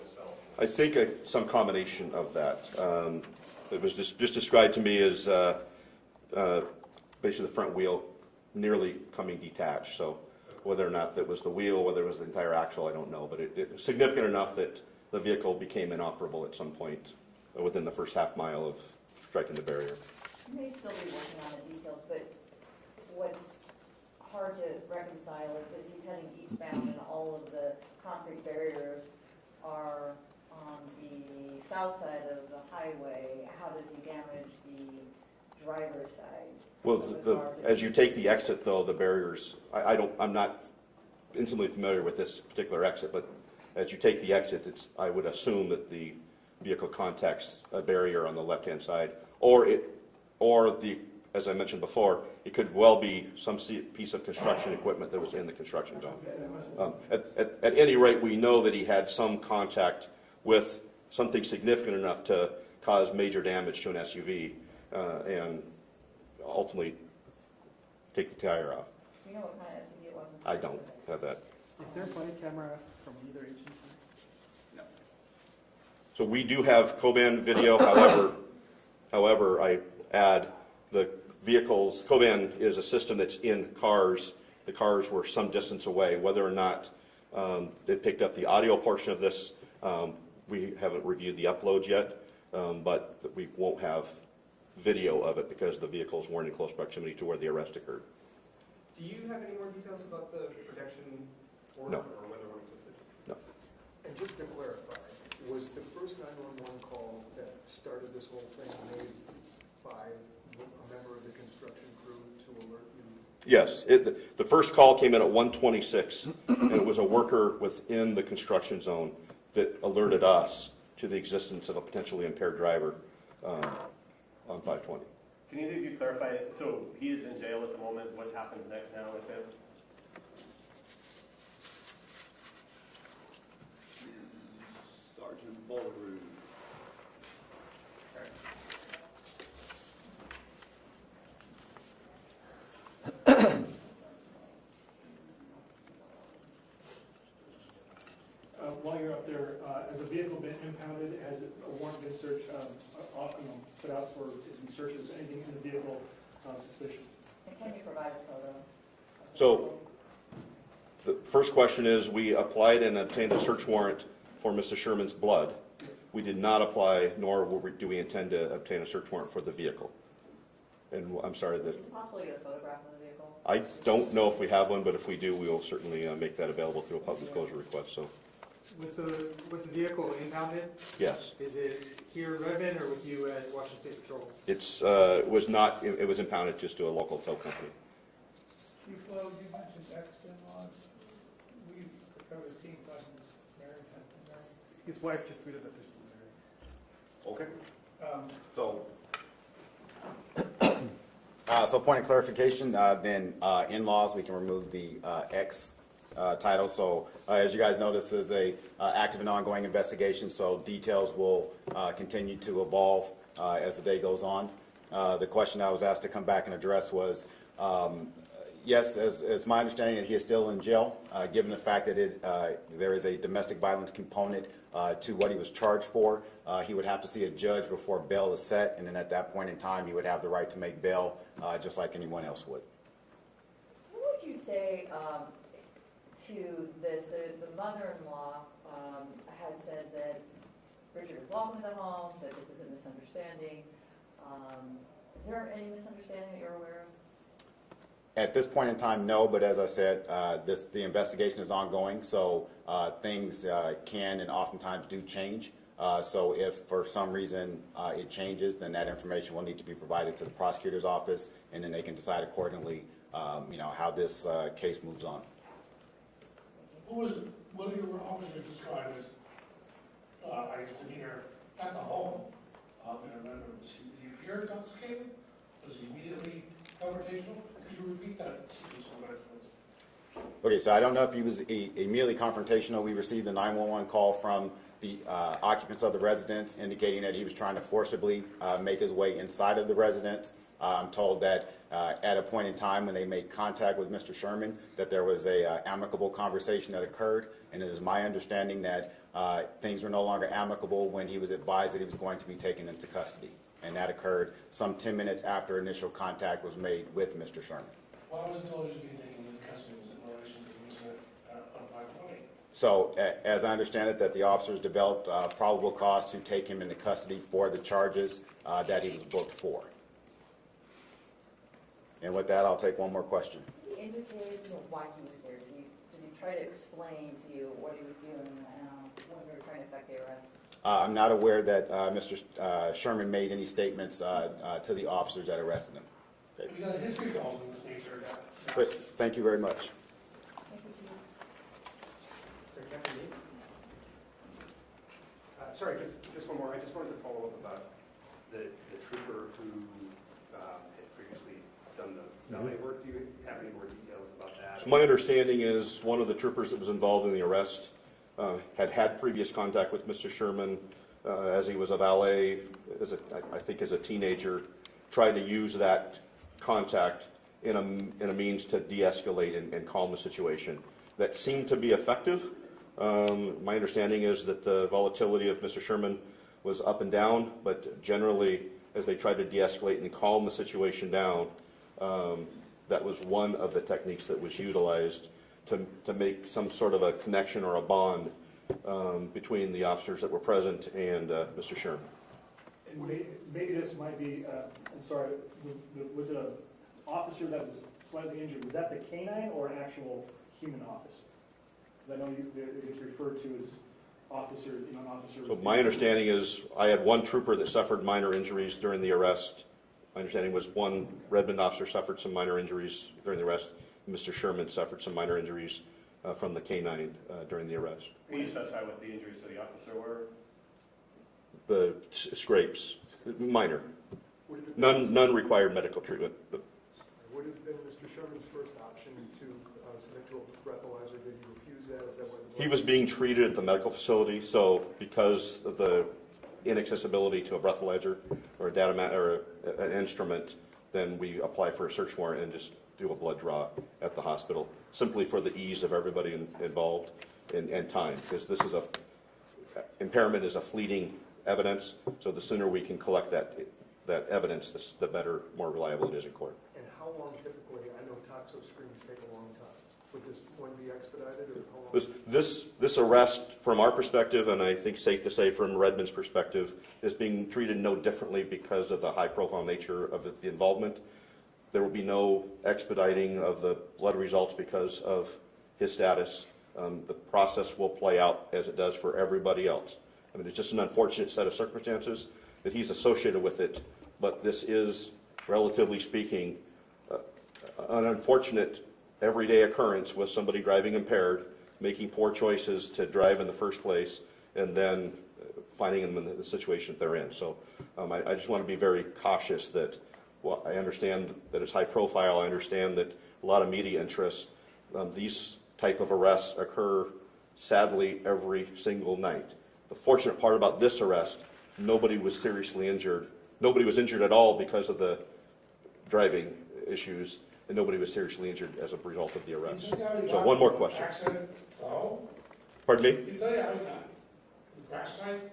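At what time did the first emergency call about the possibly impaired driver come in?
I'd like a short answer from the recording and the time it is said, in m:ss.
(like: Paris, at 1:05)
1:26, at 1:55.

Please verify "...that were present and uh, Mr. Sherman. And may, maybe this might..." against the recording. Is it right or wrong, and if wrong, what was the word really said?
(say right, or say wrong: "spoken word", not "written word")
right.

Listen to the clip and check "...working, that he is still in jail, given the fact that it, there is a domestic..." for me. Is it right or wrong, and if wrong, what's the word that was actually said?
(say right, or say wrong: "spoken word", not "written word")
wrong: "understanding", not "working".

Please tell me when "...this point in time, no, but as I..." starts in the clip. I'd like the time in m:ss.
4:08.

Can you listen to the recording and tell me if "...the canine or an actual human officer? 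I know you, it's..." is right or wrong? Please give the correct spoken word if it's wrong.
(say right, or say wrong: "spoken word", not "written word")
right.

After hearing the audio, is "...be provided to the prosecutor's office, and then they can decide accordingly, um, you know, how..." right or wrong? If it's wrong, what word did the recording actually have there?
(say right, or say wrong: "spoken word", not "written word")
right.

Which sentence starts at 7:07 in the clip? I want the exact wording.
Sherman's first option to uh, submit to a breathalyzer?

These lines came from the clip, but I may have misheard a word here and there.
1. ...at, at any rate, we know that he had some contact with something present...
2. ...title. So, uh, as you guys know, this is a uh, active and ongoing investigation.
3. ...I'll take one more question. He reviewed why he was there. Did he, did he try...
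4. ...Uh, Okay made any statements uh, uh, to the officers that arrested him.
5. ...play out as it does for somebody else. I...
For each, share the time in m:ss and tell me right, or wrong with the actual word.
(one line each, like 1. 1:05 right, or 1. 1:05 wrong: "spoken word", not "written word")
1. 0:57 wrong: "significant", not "present"
2. 3:26 right
3. 5:22 wrong: "indicated", not "reviewed"
4. 5:32 wrong: "Sherman", not "Okay"
5. 7:57 wrong: "everybody", not "somebody".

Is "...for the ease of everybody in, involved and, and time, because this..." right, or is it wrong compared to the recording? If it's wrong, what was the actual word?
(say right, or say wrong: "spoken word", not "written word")
right.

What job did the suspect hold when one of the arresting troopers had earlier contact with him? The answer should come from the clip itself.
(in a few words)
valet.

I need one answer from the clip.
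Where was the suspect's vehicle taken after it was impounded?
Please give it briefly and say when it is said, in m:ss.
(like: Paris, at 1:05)
local tow company, at 3:06.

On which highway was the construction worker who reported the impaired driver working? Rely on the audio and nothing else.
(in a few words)
520.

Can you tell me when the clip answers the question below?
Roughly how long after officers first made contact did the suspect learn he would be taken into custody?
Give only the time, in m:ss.
5:04.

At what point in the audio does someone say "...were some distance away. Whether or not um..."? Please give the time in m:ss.
1:25.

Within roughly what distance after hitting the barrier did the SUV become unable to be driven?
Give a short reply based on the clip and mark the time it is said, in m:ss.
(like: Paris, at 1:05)
half mile, at 0:17.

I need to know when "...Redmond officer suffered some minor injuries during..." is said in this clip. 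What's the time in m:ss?
6:51.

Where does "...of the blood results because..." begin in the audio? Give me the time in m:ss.
7:53.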